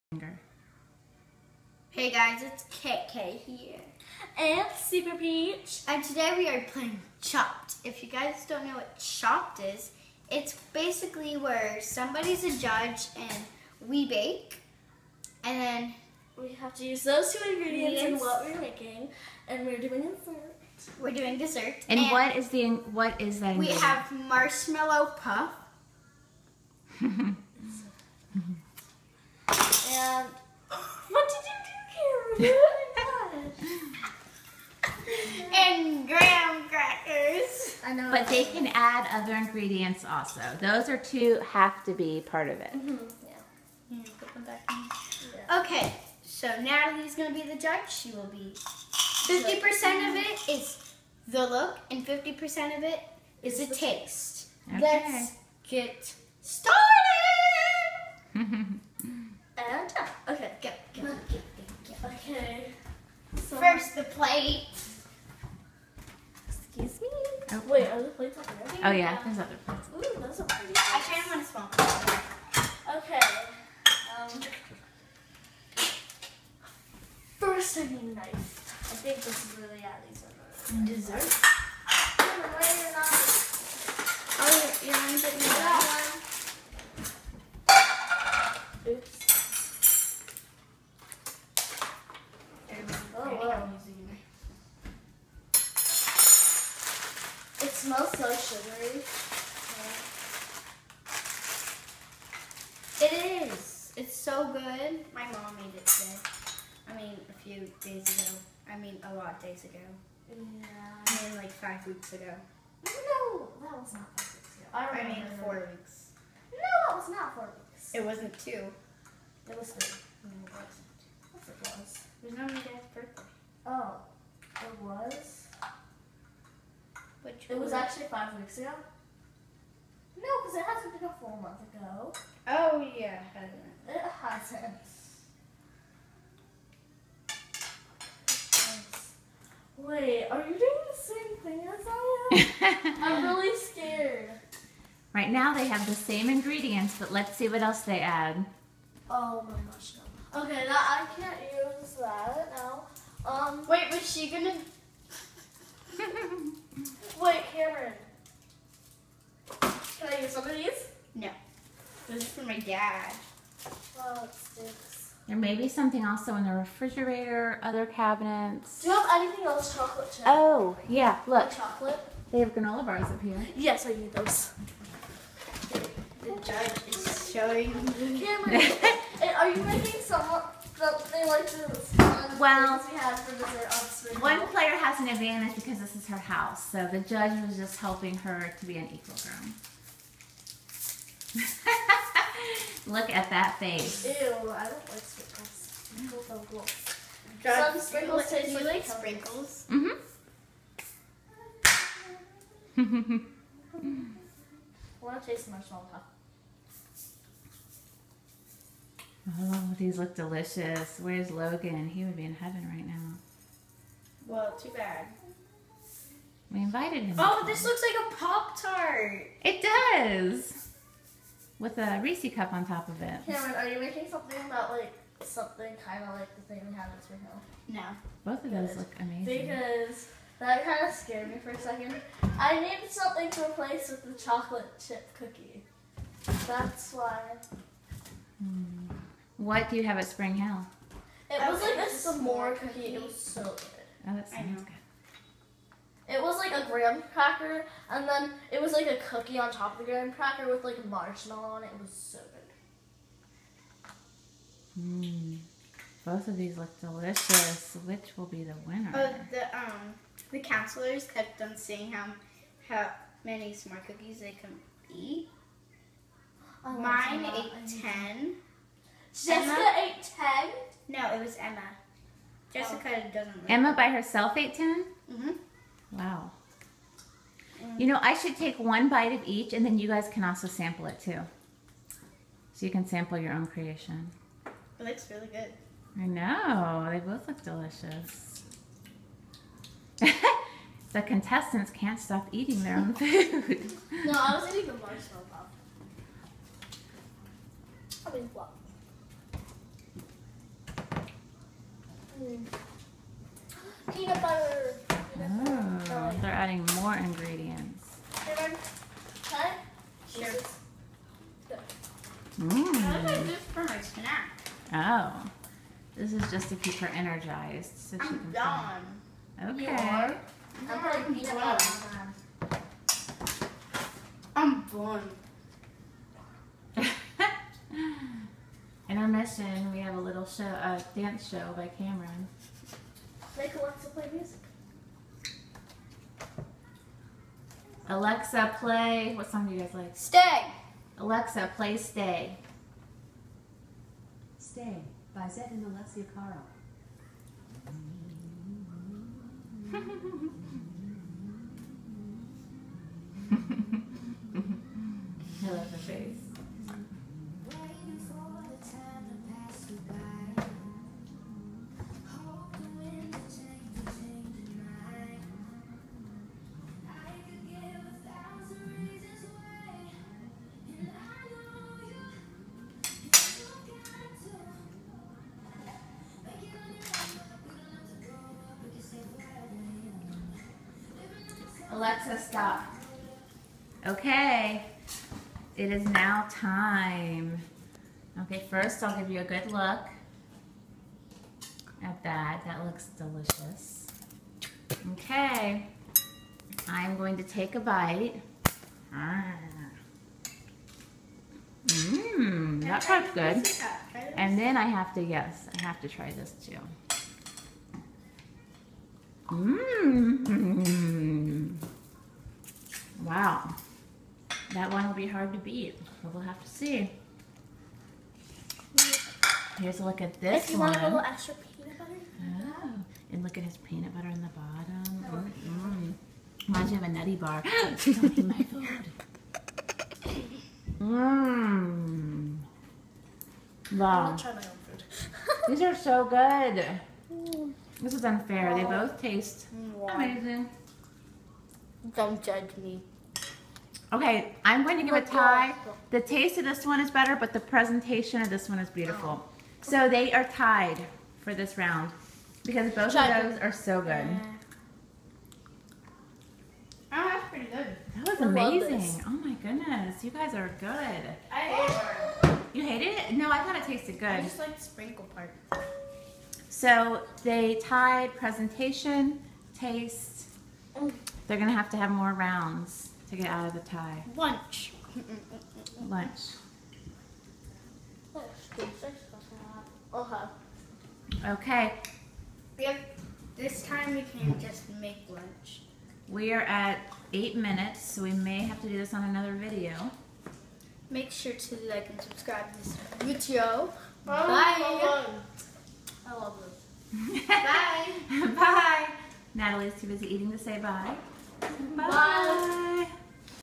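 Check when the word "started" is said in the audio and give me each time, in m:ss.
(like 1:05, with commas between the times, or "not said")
0:56.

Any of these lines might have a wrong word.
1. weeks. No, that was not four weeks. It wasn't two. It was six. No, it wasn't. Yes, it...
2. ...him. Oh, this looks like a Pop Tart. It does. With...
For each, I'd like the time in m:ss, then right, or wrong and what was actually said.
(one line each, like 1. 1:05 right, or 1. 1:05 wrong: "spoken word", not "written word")
1. 1:55 wrong: "three", not "six"
2. 3:37 right.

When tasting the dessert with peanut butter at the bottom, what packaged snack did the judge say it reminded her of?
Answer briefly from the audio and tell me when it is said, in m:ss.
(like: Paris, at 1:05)
nutty bar, at 7:06.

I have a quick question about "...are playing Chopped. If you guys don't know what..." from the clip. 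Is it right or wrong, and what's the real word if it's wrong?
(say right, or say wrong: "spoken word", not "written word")
right.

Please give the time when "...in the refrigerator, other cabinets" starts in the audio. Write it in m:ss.
2:46.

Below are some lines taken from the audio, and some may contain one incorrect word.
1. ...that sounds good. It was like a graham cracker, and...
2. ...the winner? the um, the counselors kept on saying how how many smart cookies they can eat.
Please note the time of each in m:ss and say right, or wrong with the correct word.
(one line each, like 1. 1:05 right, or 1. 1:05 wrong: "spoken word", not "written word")
1. 4:04 right
2. 4:18 right.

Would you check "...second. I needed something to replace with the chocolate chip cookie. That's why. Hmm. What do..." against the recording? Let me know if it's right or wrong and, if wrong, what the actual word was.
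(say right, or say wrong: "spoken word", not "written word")
right.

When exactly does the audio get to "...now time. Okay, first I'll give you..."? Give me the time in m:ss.
6:25.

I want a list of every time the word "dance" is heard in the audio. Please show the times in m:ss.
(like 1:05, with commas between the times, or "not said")
5:30.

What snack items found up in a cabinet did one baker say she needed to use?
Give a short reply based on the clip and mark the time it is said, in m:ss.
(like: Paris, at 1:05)
granola bars, at 2:52.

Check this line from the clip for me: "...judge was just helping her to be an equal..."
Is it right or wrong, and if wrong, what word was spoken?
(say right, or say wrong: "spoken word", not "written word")
right.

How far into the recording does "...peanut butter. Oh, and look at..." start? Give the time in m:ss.
7:01.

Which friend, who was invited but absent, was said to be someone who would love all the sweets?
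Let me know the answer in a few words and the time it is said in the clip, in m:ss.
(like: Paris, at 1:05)
Logan, at 3:31.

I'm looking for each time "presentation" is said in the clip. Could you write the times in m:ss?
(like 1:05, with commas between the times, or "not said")
7:27, 7:48.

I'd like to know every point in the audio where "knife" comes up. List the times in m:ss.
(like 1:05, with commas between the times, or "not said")
1:18.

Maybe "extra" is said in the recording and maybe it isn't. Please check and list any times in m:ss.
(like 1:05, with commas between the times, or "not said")
7:01.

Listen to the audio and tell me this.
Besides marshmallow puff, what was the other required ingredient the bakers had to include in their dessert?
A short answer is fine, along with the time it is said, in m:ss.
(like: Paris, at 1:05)
graham crackers, at 0:36.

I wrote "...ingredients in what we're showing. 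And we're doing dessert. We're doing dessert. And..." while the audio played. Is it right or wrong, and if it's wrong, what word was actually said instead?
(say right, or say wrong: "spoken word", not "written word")
wrong: "making", not "showing".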